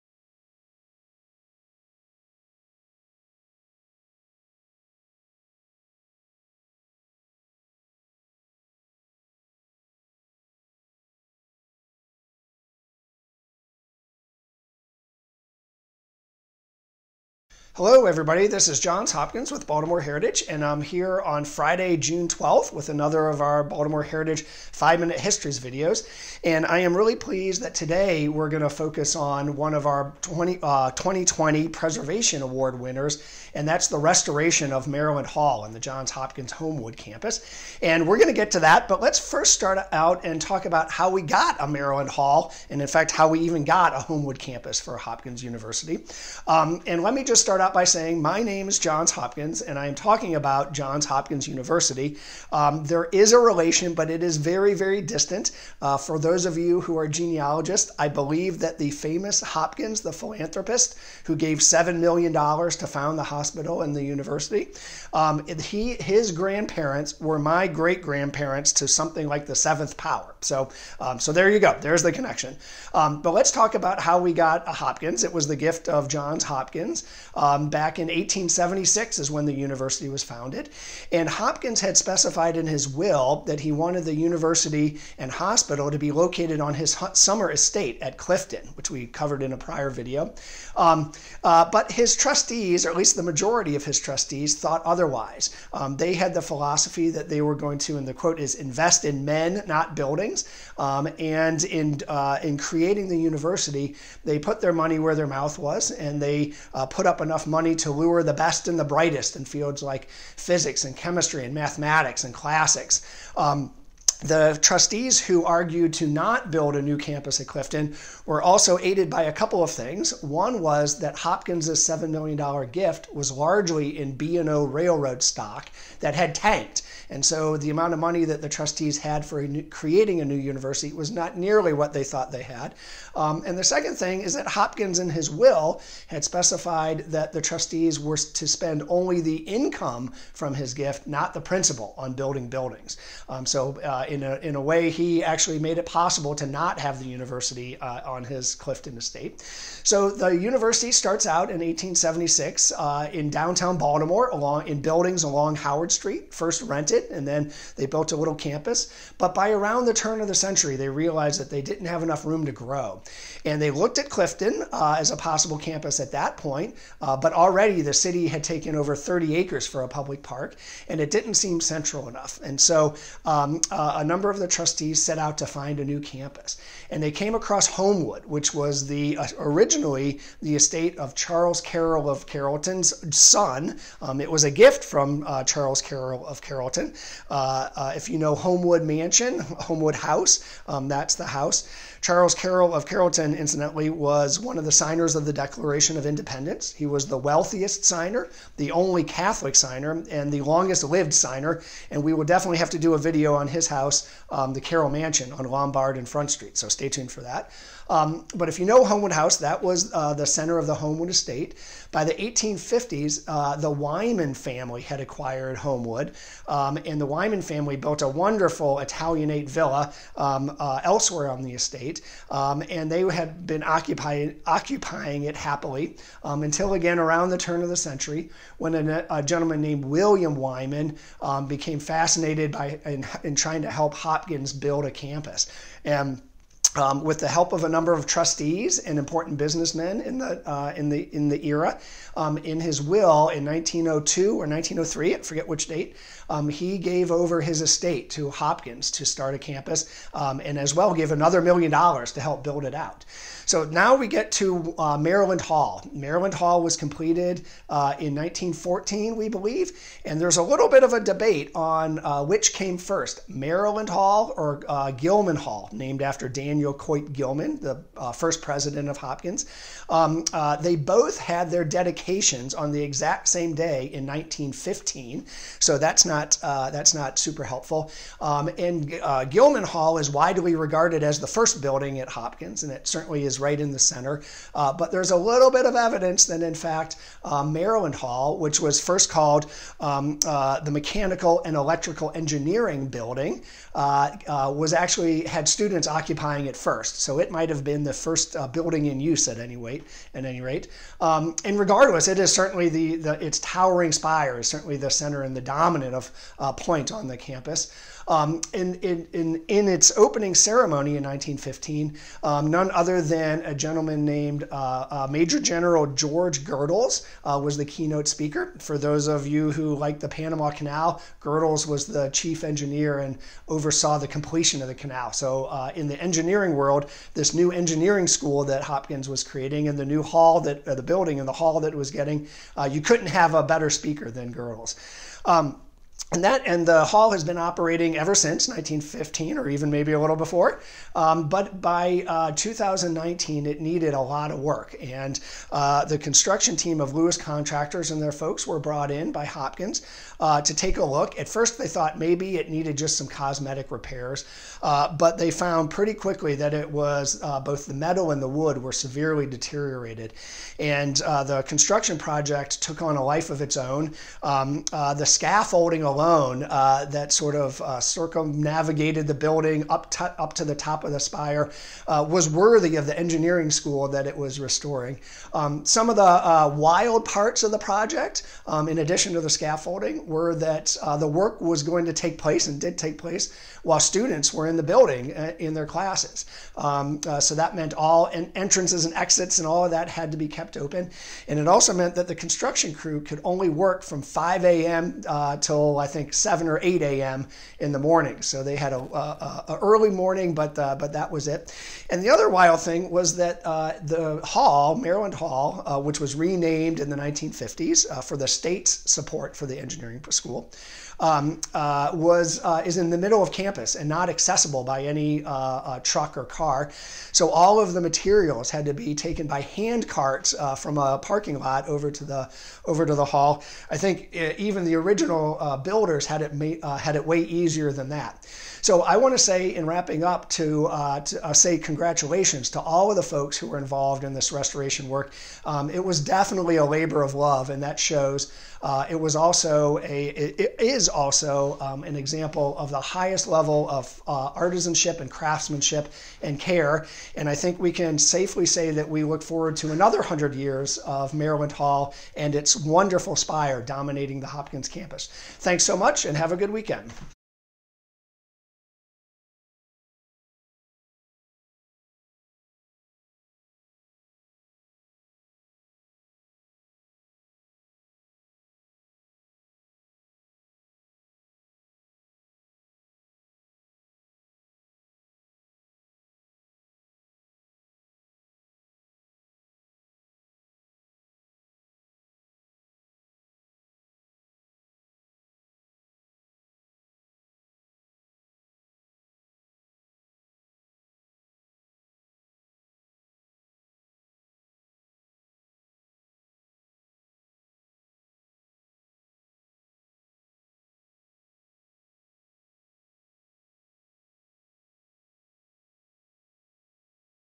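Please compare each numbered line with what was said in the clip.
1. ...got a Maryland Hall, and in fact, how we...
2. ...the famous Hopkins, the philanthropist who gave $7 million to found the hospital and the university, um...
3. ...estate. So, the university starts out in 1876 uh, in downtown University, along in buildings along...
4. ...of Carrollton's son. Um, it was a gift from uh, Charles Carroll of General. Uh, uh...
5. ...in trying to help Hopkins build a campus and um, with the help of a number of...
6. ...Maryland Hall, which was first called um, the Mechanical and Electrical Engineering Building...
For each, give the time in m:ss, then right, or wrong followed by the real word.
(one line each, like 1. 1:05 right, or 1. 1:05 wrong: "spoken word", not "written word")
1. 0:41 right
2. 0:58 right
3. 2:28 wrong: "Baltimore", not "University"
4. 3:02 wrong: "Carrollton", not "General"
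5. 3:53 right
6. 4:47 right.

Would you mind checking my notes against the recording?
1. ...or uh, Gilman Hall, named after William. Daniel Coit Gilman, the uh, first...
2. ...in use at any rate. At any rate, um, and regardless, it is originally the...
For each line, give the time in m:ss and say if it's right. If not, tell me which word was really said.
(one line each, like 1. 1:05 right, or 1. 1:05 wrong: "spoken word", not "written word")
1. 4:24 wrong: "Daniel", not "William"
2. 4:58 wrong: "certainly", not "originally".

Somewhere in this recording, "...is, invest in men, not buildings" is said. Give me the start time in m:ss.
1:38.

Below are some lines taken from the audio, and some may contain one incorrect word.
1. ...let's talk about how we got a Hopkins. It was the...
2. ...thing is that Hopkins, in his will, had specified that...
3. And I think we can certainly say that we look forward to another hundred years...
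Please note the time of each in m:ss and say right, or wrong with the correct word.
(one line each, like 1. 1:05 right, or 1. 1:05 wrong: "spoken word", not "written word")
1. 1:13 right
2. 2:13 right
3. 7:27 wrong: "safely", not "certainly".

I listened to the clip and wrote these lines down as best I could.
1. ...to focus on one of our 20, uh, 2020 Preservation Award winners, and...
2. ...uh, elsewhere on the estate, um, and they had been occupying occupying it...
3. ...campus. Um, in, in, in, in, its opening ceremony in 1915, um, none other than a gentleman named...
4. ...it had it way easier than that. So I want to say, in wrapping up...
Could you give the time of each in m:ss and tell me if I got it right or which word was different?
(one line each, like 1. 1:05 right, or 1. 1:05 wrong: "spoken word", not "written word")
1. 0:28 right
2. 3:40 right
3. 5:07 right
4. 7:06 right.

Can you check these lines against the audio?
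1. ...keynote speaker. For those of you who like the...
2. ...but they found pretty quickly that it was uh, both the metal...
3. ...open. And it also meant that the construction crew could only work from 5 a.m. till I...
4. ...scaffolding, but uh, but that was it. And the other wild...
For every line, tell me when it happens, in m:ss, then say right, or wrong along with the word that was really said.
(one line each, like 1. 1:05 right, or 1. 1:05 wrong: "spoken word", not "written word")
1. 5:17 right
2. 5:54 right
3. 6:30 right
4. 6:39 wrong: "morning", not "scaffolding".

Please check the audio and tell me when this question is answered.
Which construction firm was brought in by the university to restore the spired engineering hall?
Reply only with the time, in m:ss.
5:46.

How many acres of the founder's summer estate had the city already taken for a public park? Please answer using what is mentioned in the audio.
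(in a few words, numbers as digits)
30.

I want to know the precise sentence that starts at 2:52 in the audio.
And so um, uh, a number of the trustees set out to find a new campus.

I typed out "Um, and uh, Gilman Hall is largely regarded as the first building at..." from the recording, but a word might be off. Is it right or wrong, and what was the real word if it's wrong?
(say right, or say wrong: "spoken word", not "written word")
wrong: "widely", not "largely".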